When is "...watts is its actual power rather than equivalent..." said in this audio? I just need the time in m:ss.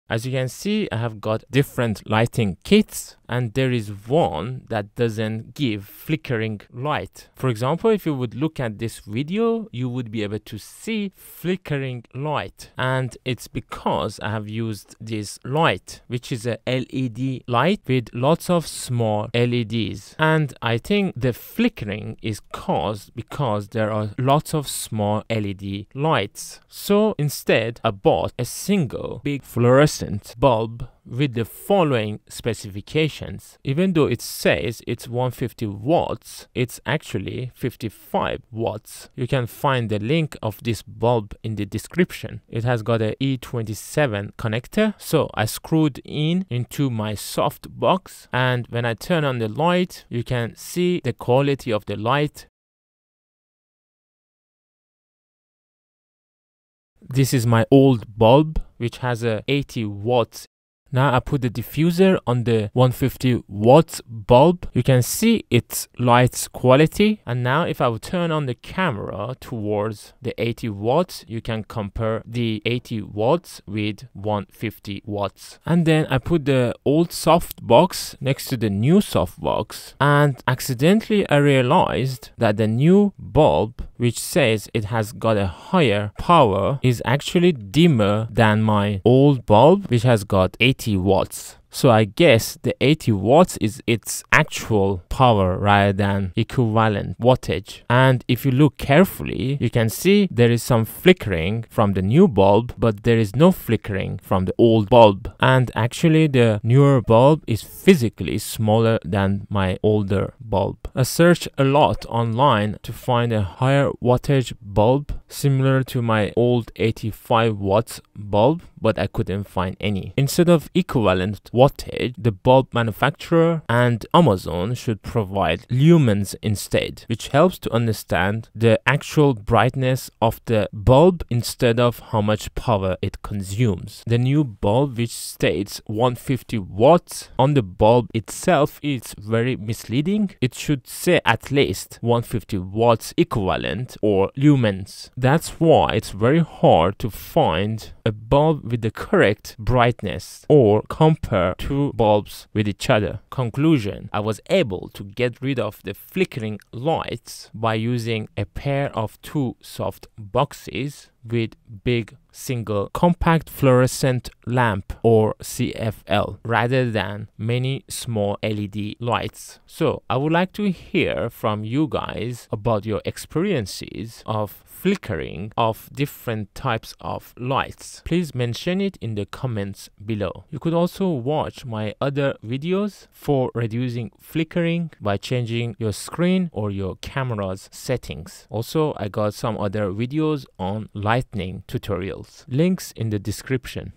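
1:33.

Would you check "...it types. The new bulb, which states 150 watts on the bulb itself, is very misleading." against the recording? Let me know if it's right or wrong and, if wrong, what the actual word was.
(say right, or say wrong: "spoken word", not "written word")
wrong: "consumes", not "types".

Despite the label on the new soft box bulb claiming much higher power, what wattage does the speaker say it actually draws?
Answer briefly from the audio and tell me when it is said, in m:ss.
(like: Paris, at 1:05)
55 watts, at 0:37.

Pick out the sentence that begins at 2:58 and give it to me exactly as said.
Please mention it in the comments below.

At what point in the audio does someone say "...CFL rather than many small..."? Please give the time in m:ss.
2:45.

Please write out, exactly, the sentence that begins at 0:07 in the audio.
For example, if you would look at this video, you would be able to see flickering light.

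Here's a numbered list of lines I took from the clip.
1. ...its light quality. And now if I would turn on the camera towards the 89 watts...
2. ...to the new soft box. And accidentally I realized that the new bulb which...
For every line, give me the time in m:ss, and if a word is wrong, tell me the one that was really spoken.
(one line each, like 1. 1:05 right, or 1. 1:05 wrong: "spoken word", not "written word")
1. 1:05 wrong: "80", not "89"
2. 1:18 right.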